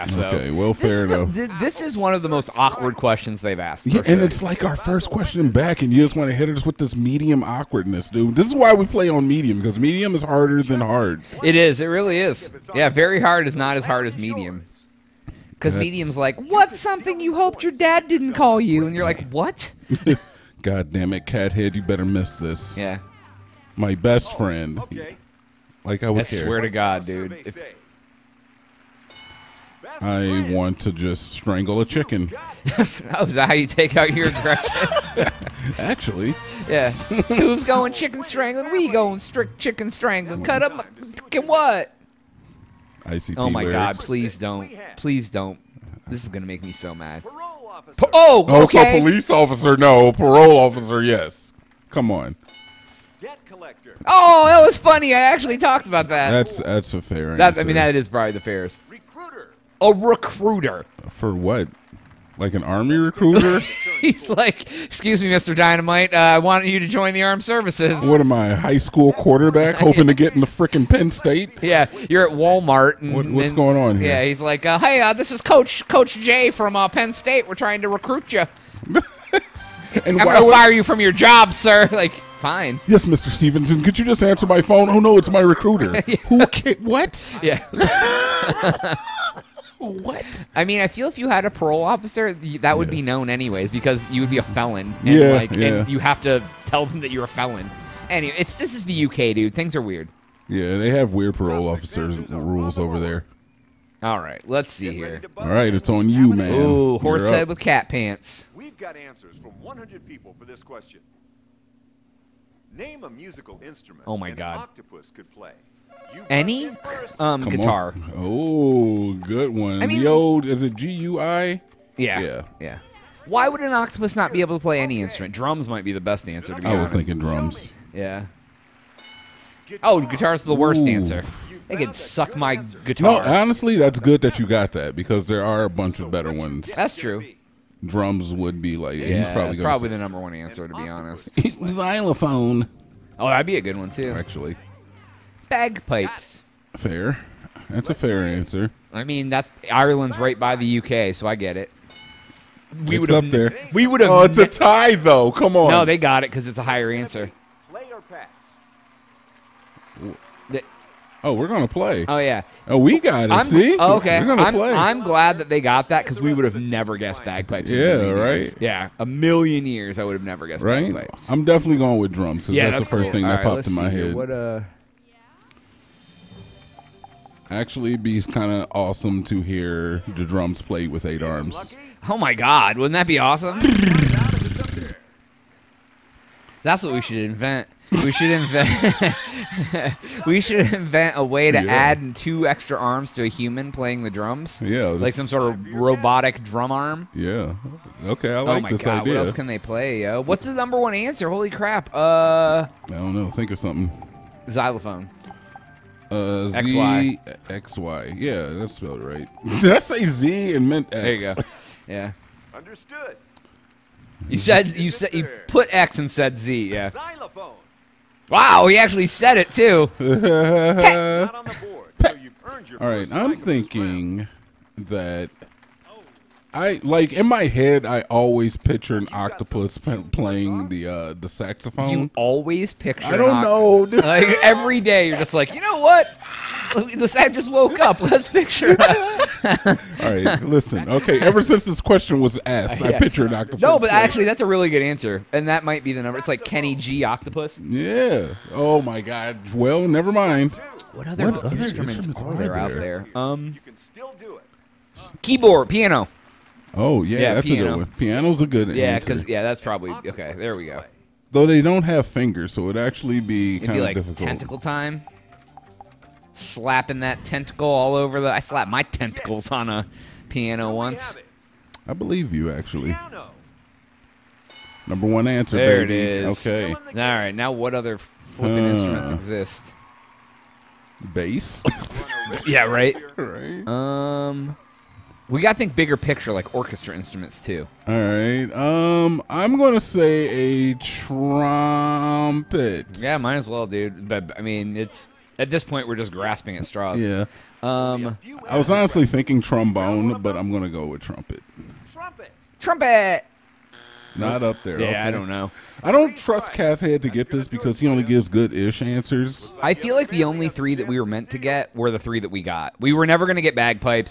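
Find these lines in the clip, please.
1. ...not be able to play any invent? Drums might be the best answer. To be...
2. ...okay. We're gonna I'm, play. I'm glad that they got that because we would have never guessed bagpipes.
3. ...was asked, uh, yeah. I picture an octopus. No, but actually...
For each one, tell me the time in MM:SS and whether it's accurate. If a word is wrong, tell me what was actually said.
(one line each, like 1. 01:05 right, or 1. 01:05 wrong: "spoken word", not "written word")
1. 02:04 wrong: "instrument", not "invent"
2. 02:43 right
3. 04:02 right.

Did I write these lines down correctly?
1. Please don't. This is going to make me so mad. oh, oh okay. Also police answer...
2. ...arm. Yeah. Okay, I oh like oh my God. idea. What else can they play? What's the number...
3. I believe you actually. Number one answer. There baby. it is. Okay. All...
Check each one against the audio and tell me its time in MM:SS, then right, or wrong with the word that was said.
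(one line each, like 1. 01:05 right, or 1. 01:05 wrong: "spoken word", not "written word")
1. 00:44 wrong: "officer", not "answer"
2. 03:16 right
3. 04:31 right.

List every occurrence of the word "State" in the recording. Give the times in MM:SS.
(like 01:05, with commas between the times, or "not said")
01:11, 01:17.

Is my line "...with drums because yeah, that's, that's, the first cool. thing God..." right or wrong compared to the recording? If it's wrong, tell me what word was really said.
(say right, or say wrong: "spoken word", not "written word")
wrong: "All", not "God".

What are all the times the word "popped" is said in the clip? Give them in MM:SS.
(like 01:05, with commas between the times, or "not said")
02:53.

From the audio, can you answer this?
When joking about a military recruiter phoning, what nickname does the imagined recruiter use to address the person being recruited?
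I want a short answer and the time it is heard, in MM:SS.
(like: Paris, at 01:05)
Mr. Dynamite, at 01:05.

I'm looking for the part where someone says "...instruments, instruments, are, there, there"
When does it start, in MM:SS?
04:11.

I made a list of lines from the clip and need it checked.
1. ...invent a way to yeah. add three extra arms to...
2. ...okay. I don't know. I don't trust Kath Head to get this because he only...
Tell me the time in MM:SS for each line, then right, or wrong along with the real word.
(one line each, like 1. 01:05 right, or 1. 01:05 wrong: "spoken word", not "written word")
1. 03:10 wrong: "two", not "three"
2. 05:04 right.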